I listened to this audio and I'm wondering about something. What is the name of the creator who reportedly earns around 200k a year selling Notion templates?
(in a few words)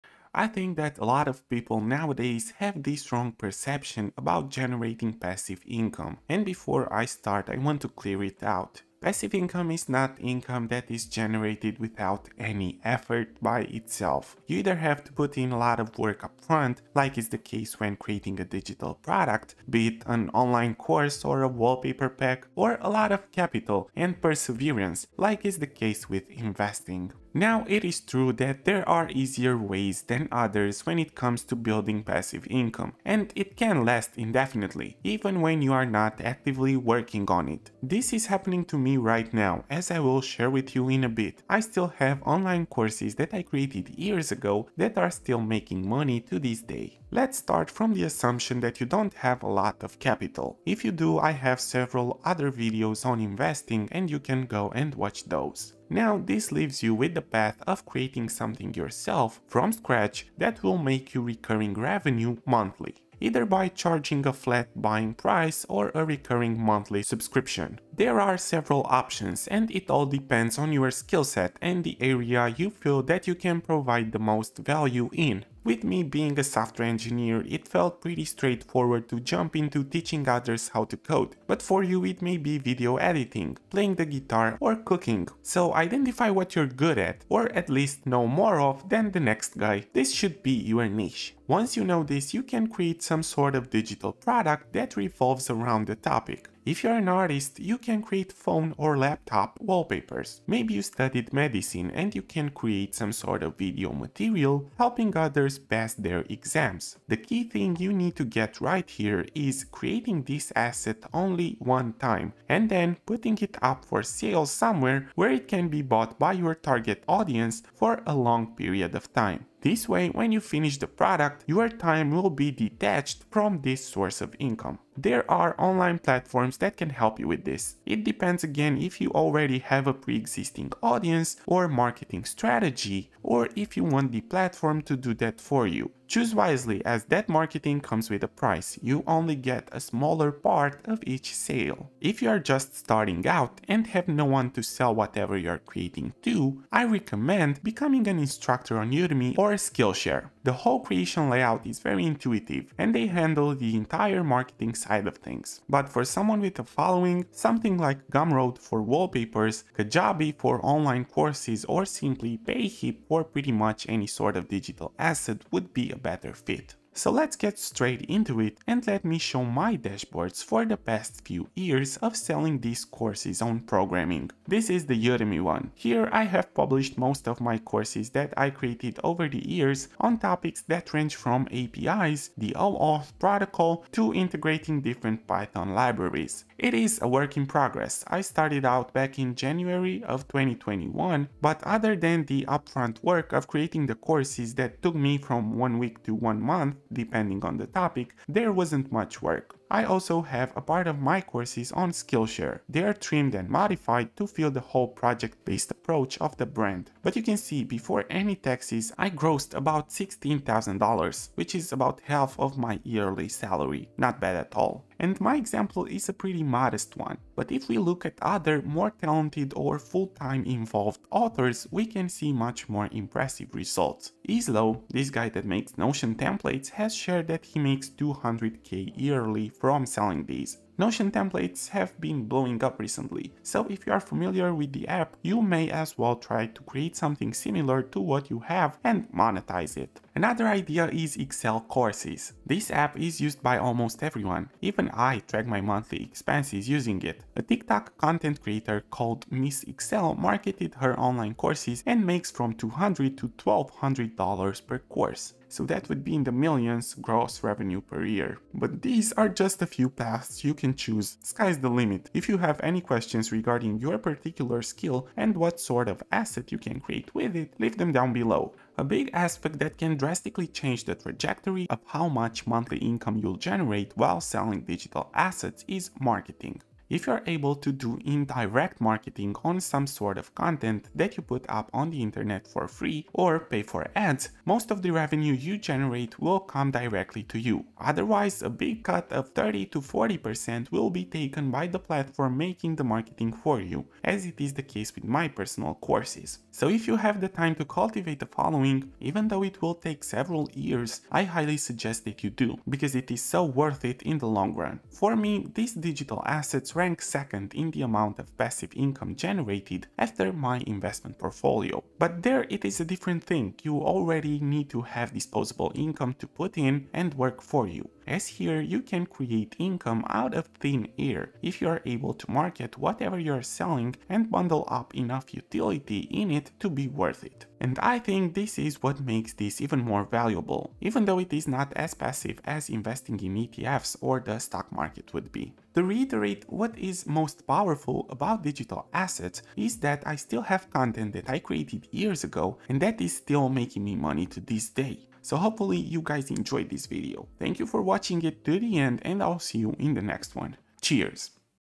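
Easlo.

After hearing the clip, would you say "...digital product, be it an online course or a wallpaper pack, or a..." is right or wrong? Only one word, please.
right.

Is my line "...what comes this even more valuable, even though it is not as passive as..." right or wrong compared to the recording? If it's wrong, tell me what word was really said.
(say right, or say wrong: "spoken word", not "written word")
wrong: "makes", not "comes".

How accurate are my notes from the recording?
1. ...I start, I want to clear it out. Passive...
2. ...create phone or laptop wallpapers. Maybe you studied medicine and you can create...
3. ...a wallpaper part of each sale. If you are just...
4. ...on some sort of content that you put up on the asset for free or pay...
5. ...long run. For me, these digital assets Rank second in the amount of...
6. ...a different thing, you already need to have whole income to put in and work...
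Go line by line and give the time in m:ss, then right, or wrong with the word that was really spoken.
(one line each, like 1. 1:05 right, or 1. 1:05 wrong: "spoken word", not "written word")
1. 0:06 right
2. 1:38 right
3. 2:19 wrong: "smaller", not "wallpaper"
4. 4:39 wrong: "internet", not "asset"
5. 5:04 right
6. 5:12 wrong: "disposable", not "whole".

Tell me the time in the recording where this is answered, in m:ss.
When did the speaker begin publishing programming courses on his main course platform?
3:09.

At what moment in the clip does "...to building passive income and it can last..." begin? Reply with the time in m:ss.
0:31.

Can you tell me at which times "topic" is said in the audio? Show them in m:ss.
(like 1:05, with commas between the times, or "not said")
1:35, 3:00, 3:17.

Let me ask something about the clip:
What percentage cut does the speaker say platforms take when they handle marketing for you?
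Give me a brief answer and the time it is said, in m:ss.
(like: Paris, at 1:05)
30 to 40%, at 4:49.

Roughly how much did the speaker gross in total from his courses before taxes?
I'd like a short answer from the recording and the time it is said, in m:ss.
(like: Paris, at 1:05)
$16,000, at 3:29.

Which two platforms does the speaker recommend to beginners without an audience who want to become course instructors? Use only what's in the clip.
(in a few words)
Udemy or Skillshare.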